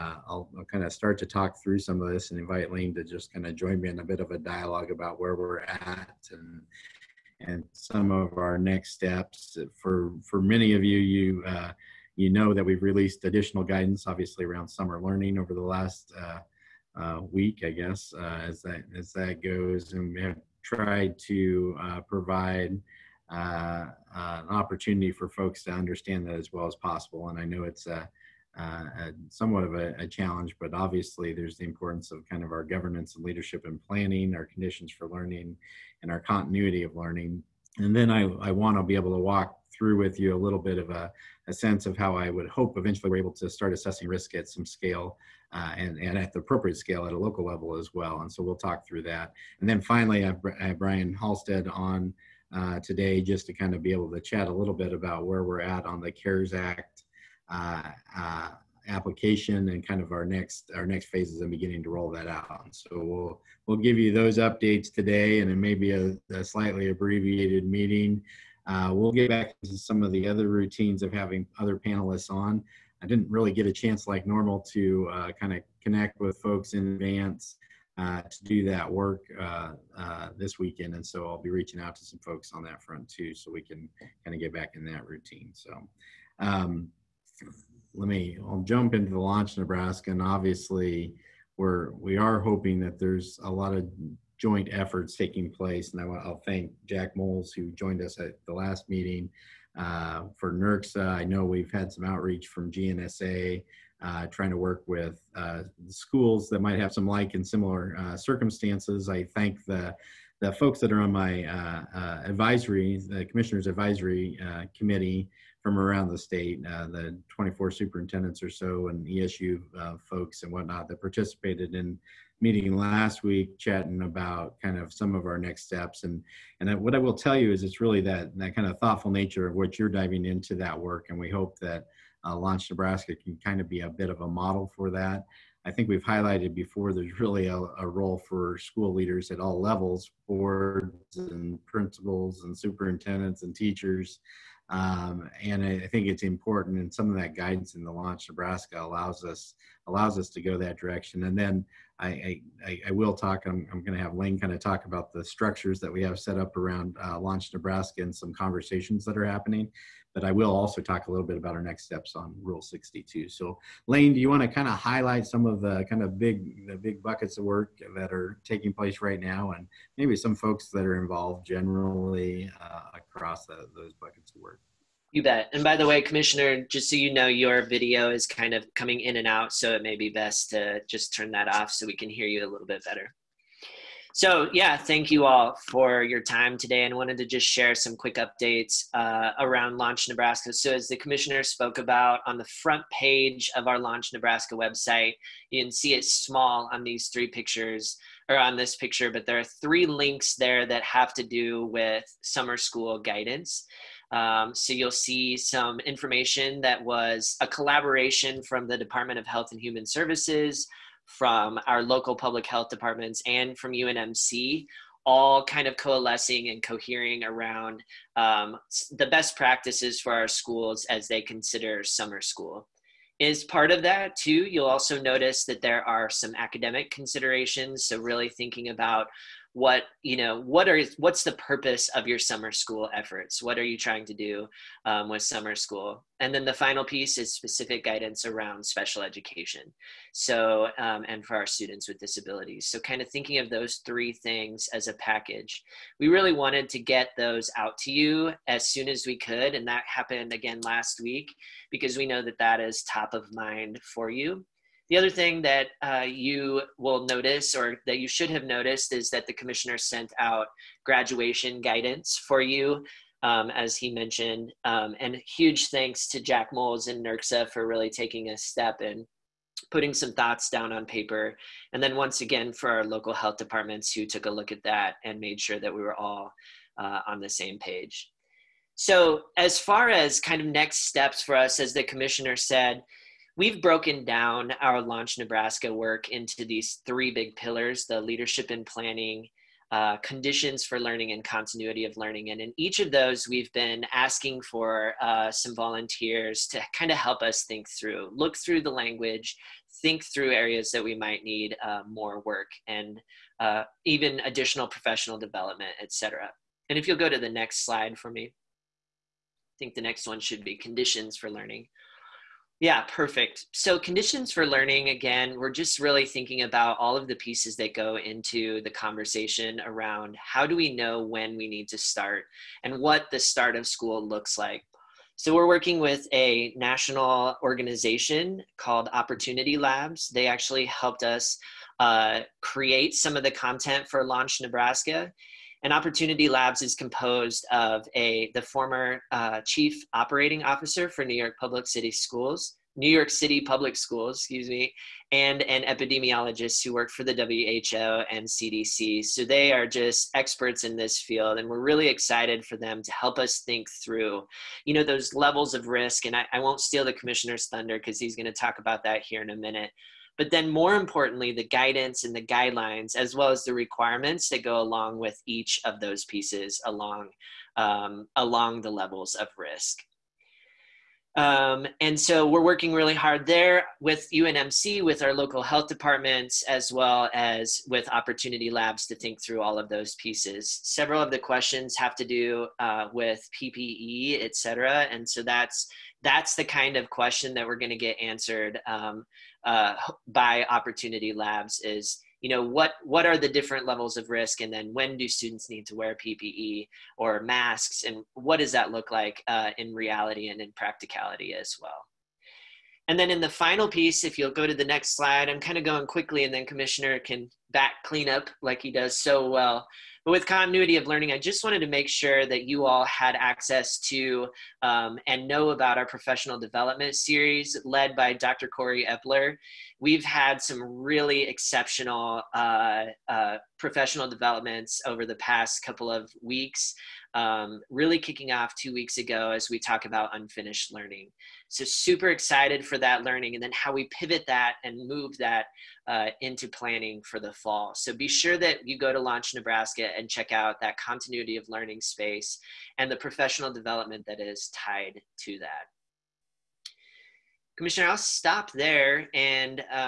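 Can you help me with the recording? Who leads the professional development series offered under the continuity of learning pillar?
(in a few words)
Dr. Cory Epler.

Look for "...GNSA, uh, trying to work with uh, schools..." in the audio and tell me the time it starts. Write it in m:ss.
1:42.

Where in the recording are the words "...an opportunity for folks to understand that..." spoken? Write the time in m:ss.
0:24.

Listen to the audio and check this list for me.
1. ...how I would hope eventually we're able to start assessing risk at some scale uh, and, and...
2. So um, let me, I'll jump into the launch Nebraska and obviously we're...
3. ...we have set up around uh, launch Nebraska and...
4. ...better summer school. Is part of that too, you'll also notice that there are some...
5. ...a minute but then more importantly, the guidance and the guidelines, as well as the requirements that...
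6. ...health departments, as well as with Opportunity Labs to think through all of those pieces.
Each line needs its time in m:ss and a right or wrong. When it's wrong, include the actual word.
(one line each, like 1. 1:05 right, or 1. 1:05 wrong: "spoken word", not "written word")
1. 0:41 right
2. 1:25 right
3. 2:35 right
4. 3:41 wrong: "consider", not "better"
5. 5:59 right
6. 6:15 right.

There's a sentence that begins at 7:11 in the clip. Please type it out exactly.
So, super excited for that learning and then how we pivot that and move that uh, into planning for the fall.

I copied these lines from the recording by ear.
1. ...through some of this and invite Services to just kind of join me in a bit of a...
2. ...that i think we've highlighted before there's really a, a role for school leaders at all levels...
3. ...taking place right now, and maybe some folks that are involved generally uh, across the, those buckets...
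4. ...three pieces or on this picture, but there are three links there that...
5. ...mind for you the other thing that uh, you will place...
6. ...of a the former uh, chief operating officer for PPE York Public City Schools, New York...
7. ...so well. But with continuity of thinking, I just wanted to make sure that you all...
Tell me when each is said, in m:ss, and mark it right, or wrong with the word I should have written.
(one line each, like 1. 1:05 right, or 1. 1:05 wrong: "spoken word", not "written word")
1. 0:01 wrong: "Lane", not "Services"
2. 2:14 right
3. 2:48 right
4. 3:17 wrong: "pictures", not "pieces"
5. 4:13 wrong: "notice", not "place"
6. 5:37 wrong: "New", not "PPE"
7. 6:48 wrong: "learning", not "thinking".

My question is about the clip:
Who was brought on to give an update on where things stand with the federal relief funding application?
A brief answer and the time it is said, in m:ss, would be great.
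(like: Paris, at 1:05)
Brian Halstead, at 0:50.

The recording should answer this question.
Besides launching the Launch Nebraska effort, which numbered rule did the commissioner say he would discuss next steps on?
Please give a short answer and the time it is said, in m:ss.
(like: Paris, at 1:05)
Rule 62, at 2:42.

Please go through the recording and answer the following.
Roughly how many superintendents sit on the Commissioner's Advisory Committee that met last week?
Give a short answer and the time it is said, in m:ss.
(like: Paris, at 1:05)
24, at 1:57.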